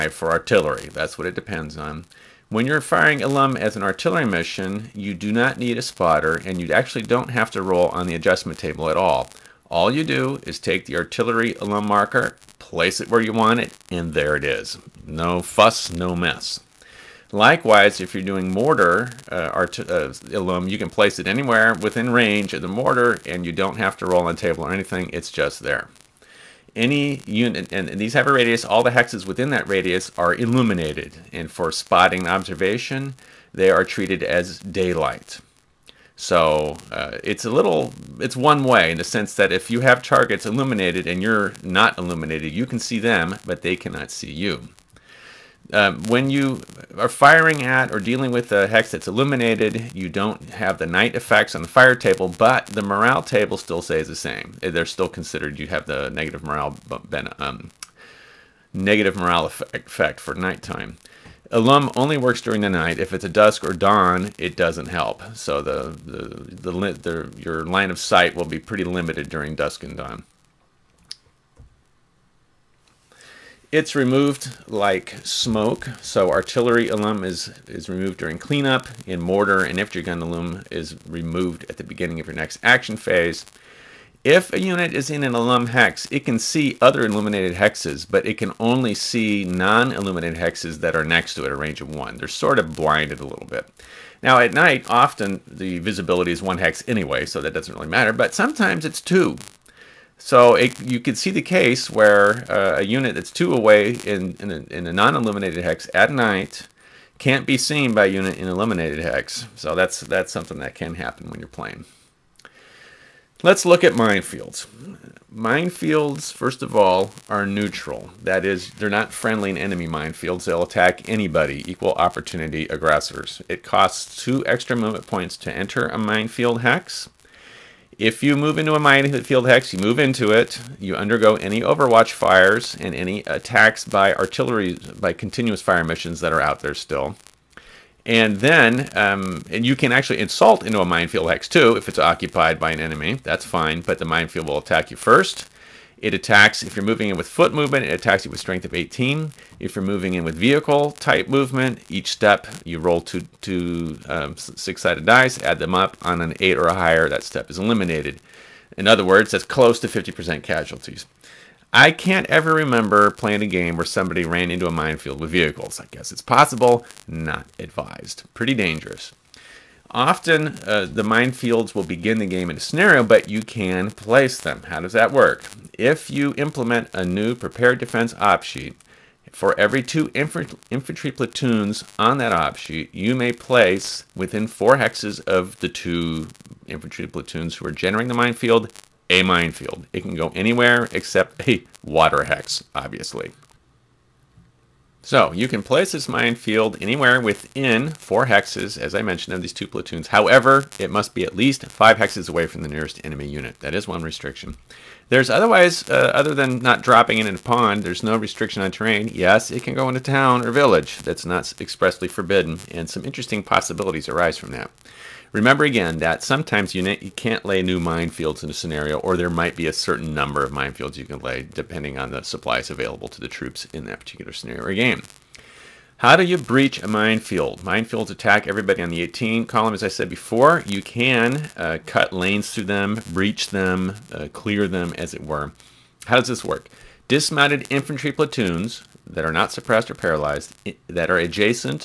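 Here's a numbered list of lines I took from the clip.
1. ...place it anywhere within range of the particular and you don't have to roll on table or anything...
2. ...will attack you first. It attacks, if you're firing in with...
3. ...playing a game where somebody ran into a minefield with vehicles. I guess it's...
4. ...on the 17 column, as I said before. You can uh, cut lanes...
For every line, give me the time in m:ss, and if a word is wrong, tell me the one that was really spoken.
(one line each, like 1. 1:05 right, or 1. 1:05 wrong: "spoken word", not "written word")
1. 0:20 wrong: "mortar", not "particular"
2. 2:24 wrong: "moving", not "firing"
3. 2:43 right
4. 3:48 wrong: "18", not "17".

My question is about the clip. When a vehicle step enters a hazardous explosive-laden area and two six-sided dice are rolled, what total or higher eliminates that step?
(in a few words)
8.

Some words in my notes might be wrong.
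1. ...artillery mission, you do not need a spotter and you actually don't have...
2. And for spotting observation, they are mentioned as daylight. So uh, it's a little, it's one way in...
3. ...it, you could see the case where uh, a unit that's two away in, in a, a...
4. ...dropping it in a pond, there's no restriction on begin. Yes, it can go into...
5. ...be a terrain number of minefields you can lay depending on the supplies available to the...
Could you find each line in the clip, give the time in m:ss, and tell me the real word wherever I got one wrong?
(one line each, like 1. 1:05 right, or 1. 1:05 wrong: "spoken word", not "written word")
1. 0:03 right
2. 0:31 wrong: "treated", not "mentioned"
3. 1:40 right
4. 3:26 wrong: "terrain", not "begin"
5. 3:39 wrong: "certain", not "terrain".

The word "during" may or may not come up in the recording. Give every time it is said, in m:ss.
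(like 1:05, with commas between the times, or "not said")
1:02, 1:09, 1:18.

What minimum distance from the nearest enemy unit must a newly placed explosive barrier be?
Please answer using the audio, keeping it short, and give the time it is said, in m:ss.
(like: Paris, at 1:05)
5 hexes, at 3:21.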